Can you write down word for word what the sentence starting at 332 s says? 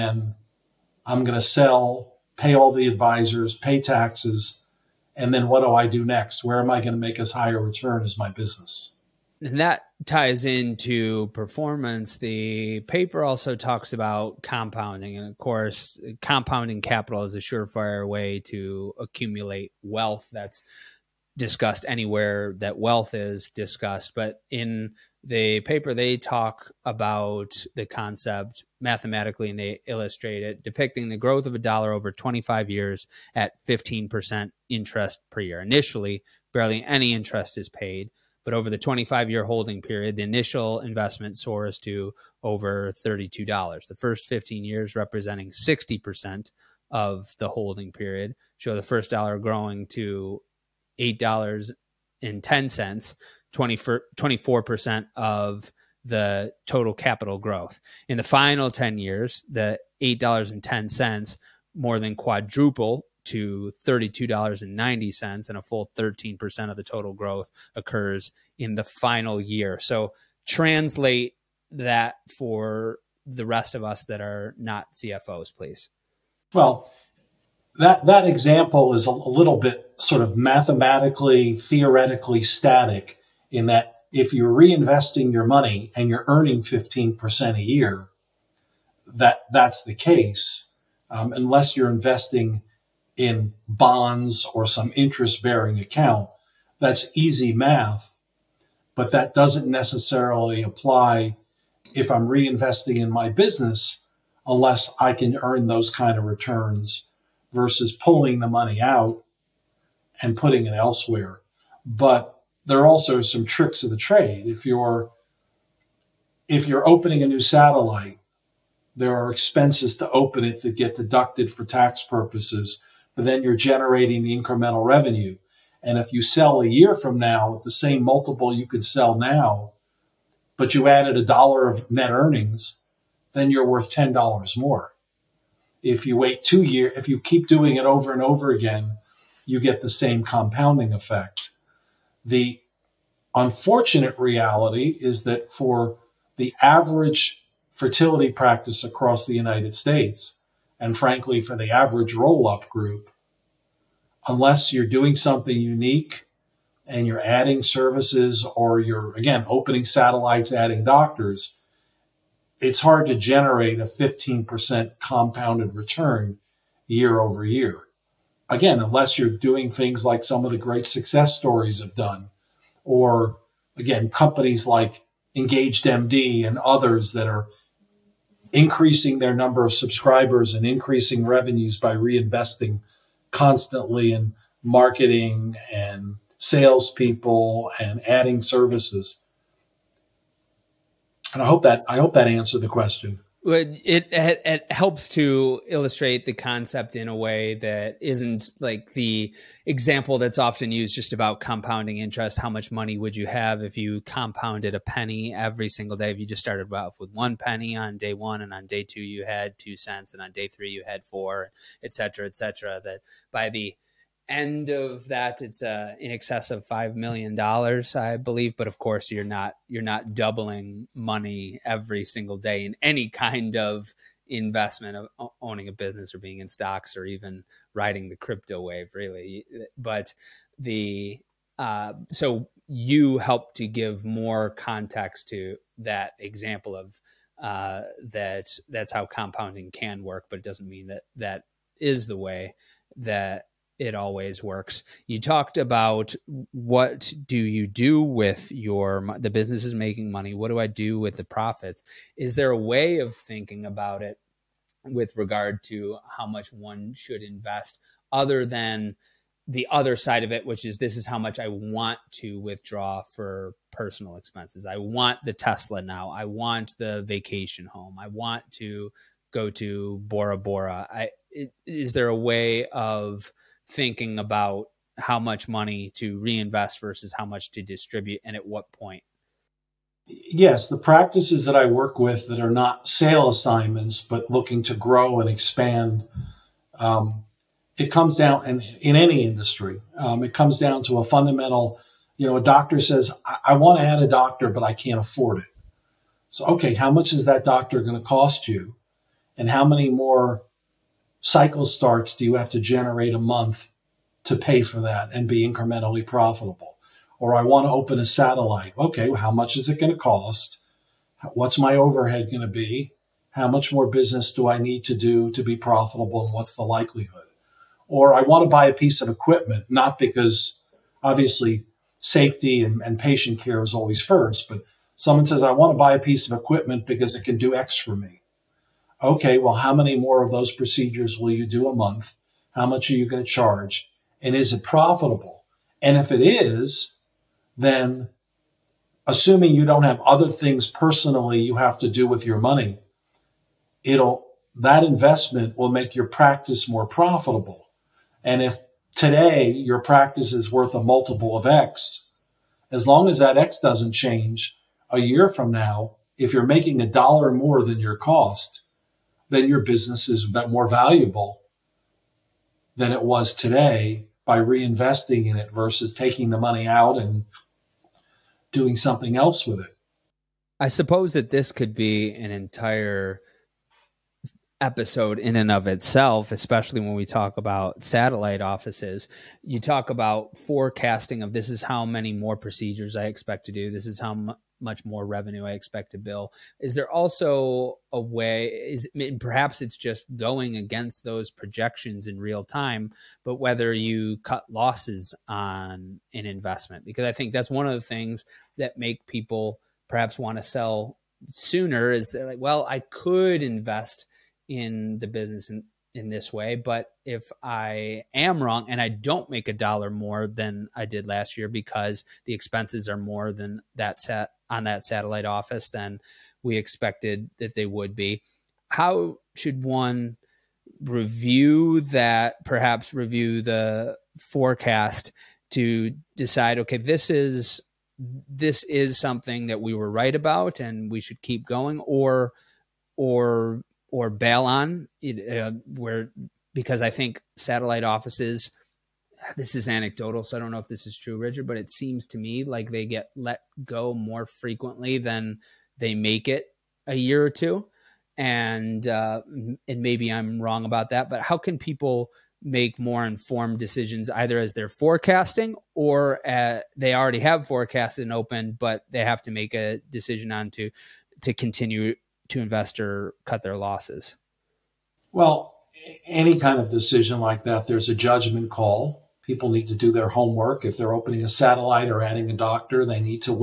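How much are you going to charge?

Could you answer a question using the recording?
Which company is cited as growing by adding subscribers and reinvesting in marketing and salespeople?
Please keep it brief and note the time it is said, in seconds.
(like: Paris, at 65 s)
Engaged MD, at 175 s.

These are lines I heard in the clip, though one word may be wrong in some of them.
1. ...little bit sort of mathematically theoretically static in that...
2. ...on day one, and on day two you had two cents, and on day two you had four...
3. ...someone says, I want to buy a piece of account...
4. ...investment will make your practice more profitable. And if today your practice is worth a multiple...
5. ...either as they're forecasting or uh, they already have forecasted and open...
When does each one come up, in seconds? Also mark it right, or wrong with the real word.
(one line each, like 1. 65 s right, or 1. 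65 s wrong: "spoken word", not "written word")
1. 79 s right
2. 207 s wrong: "three", not "two"
3. 324 s wrong: "equipment", not "account"
4. 344 s right
5. 454 s right.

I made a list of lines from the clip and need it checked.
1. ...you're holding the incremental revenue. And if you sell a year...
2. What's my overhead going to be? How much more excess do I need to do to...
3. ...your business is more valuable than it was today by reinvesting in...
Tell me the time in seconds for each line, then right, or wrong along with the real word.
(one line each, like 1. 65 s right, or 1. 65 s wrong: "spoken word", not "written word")
1. 123 s wrong: "generating", not "holding"
2. 311 s wrong: "business", not "excess"
3. 359 s right.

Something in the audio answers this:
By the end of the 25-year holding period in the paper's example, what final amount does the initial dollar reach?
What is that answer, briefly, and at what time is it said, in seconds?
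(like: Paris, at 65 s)
$32.90, at 63 s.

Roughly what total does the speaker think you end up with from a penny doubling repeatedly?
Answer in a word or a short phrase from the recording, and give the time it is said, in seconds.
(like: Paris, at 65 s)
5 million dollars, at 216 s.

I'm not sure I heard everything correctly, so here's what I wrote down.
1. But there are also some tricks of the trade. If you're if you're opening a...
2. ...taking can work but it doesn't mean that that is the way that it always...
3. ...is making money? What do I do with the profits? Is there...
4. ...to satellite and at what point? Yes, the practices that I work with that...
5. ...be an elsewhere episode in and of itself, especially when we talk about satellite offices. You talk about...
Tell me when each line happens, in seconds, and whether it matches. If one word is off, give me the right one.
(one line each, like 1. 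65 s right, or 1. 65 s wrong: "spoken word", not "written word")
1. 111 s right
2. 239 s wrong: "compounding", not "taking"
3. 249 s right
4. 277 s wrong: "distribute", not "satellite"
5. 371 s wrong: "entire", not "elsewhere".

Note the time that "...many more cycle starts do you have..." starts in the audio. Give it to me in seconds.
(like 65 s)
299 s.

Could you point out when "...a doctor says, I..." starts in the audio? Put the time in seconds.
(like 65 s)
292 s.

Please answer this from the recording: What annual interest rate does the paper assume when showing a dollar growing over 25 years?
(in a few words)
15%.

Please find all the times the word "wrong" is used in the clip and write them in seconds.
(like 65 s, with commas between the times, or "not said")
408 s, 450 s.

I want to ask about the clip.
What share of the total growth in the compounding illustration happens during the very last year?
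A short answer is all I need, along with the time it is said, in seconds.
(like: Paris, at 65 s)
13%, at 65 s.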